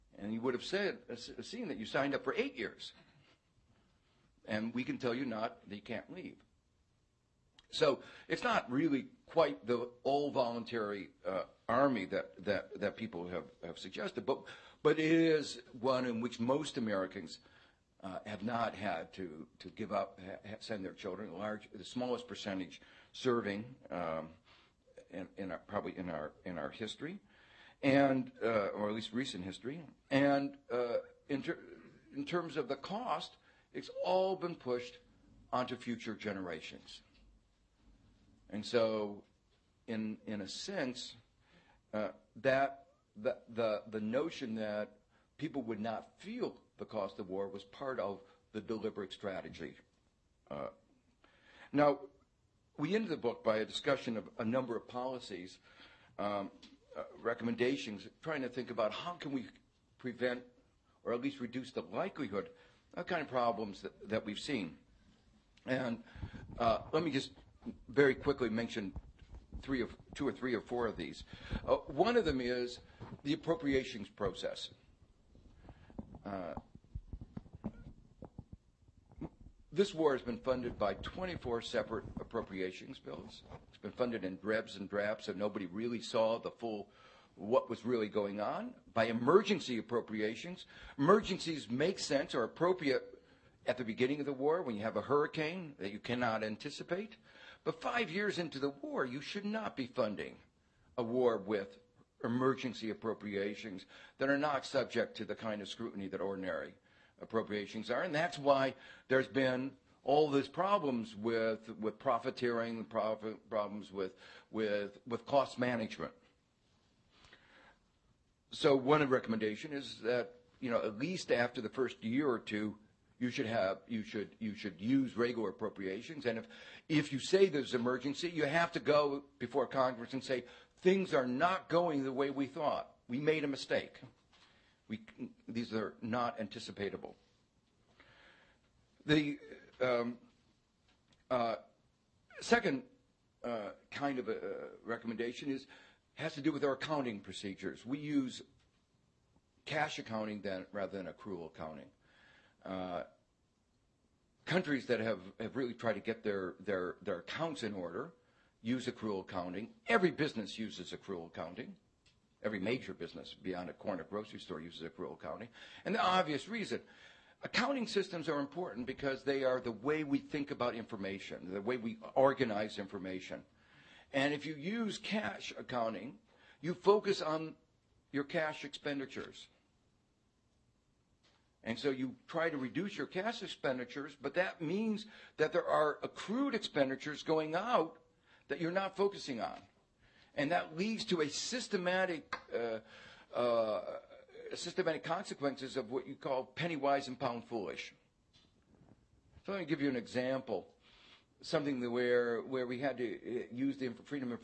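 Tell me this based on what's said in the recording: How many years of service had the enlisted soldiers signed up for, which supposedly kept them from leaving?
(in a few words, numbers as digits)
8 years.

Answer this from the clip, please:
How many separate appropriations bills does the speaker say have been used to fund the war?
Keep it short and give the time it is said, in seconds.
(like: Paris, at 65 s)
24, at 80 s.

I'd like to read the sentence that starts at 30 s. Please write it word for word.
And uh, in, ter- in terms of the cost, it's all been pushed onto future generations.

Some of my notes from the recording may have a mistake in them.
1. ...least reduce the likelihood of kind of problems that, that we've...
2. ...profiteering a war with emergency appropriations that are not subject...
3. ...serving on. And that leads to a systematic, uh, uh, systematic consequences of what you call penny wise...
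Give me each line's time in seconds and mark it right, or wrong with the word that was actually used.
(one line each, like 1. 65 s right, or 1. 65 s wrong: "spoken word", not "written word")
1. 61 s right
2. 99 s wrong: "funding", not "profiteering"
3. 188 s wrong: "focusing", not "serving".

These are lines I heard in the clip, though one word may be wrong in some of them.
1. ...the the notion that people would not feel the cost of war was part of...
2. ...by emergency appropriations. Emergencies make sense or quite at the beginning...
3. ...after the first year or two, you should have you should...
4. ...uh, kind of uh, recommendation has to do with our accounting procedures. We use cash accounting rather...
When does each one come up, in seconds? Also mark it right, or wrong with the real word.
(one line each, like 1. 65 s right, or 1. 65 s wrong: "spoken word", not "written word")
1. 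43 s right
2. 88 s wrong: "appropriate", not "quite"
3. 121 s right
4. 143 s right.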